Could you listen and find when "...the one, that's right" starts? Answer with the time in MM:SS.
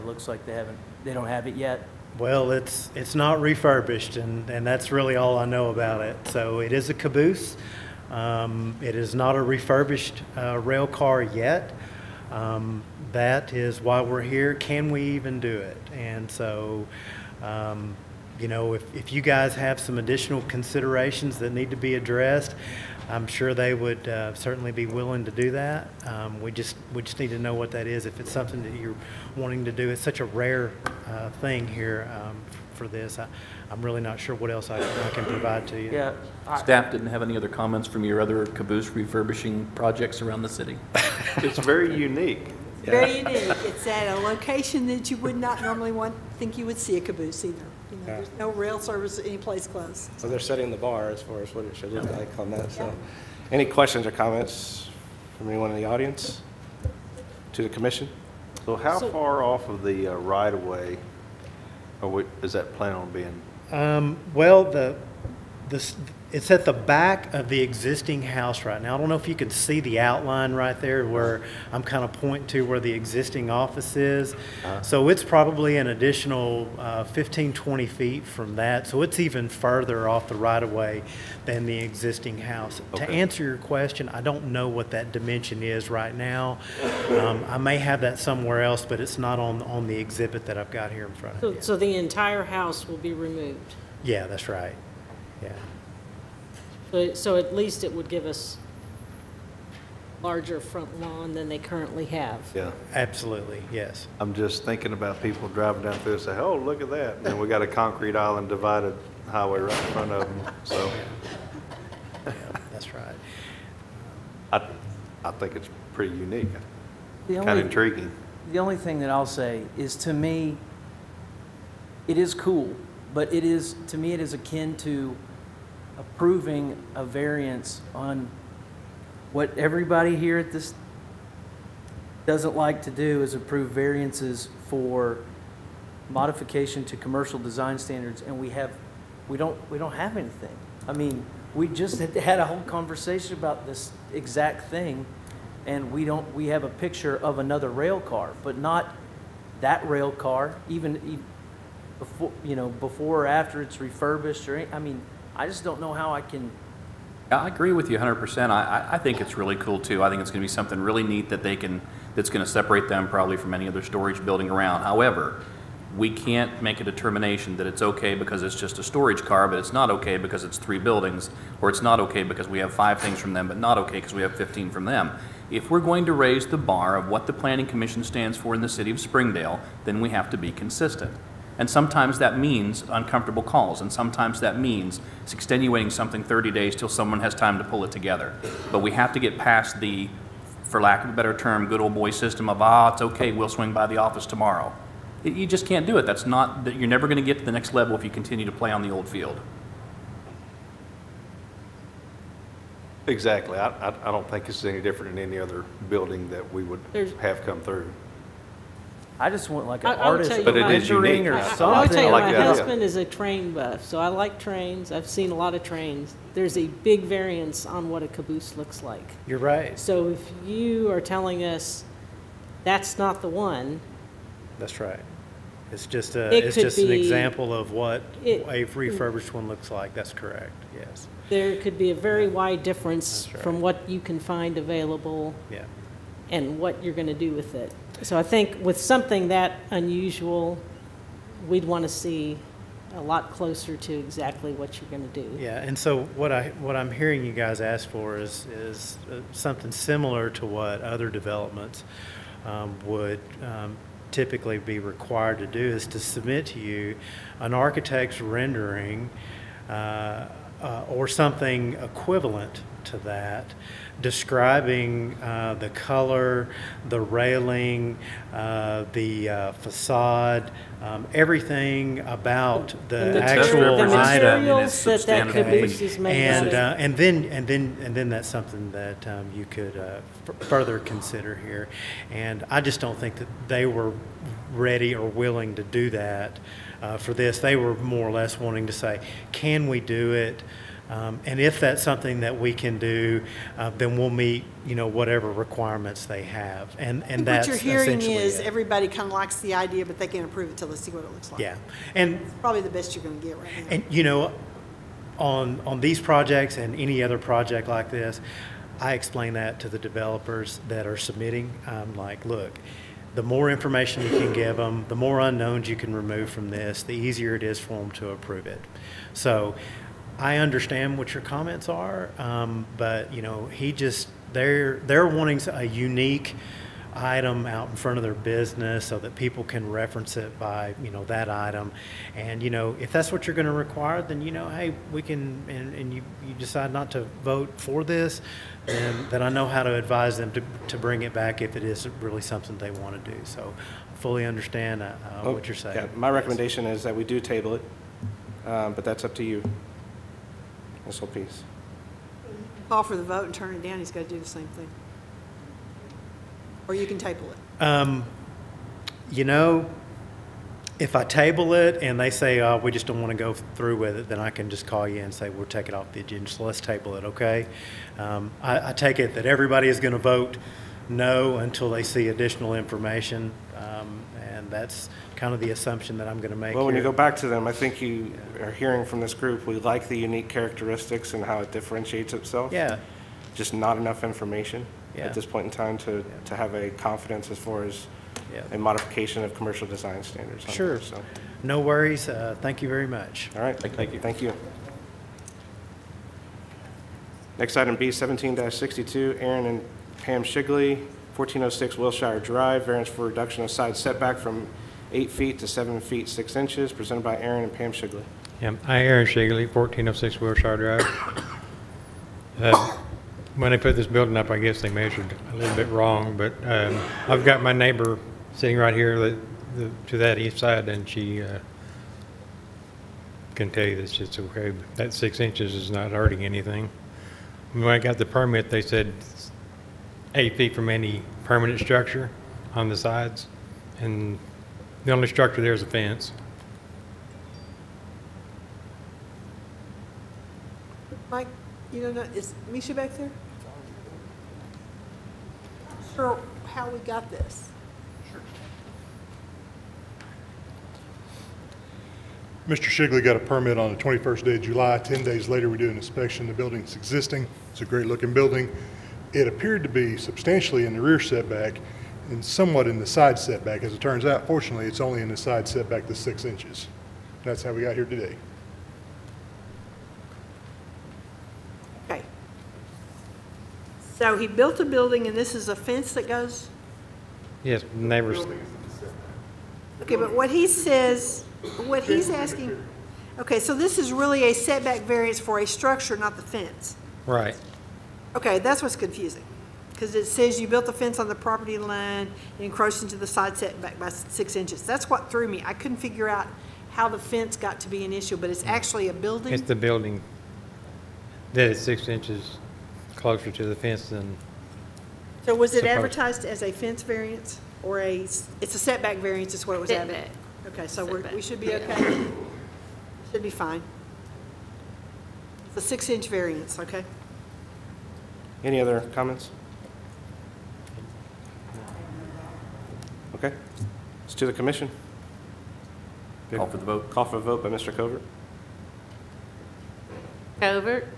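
03:43.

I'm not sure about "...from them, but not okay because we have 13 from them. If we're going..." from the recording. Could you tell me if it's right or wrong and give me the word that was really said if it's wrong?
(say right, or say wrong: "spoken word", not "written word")
wrong: "15", not "13".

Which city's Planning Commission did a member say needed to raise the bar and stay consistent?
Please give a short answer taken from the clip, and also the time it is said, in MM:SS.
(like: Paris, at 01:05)
Springdale, at 02:58.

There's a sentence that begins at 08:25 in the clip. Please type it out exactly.
So was it advertised as a fence variance or a, it's a setback variance is what it was advertised?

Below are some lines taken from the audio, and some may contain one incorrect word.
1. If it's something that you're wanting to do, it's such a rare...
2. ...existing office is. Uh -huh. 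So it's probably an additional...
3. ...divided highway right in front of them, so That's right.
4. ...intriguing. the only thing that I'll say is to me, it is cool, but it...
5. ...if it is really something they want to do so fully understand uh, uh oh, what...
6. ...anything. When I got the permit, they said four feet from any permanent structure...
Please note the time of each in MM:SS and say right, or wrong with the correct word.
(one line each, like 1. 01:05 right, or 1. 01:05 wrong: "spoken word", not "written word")
1. 00:28 right
2. 01:12 right
3. 01:48 right
4. 01:57 right
5. 05:41 right
6. 07:06 wrong: "eight", not "four".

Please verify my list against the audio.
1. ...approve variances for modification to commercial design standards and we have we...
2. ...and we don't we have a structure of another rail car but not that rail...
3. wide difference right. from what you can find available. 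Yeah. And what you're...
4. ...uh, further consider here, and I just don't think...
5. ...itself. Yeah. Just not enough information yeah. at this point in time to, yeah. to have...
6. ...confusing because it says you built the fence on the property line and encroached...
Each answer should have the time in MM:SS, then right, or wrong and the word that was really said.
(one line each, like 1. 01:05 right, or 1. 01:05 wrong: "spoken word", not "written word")
1. 02:13 right
2. 02:25 wrong: "picture", not "structure"
3. 03:52 right
4. 04:39 right
5. 06:22 right
6. 08:08 right.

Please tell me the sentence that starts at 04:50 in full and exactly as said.
Um, and if that's something that we can do, uh, then we'll meet, you know, whatever requirements they have.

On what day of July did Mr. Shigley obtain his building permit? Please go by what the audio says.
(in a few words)
21st.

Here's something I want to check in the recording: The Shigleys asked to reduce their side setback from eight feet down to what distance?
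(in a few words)
7 feet 6 inches.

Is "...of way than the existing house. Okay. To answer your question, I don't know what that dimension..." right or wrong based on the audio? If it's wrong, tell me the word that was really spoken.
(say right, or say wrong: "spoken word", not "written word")
right.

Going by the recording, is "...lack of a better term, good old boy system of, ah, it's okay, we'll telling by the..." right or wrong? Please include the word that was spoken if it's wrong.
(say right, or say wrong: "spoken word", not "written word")
wrong: "swing", not "telling".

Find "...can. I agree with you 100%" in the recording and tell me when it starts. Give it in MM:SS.
02:36.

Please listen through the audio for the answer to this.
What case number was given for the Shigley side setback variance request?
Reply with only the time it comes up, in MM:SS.
06:37.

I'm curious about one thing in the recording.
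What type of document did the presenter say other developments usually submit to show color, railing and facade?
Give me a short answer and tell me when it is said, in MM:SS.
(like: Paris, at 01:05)
architect's rendering, at 04:17.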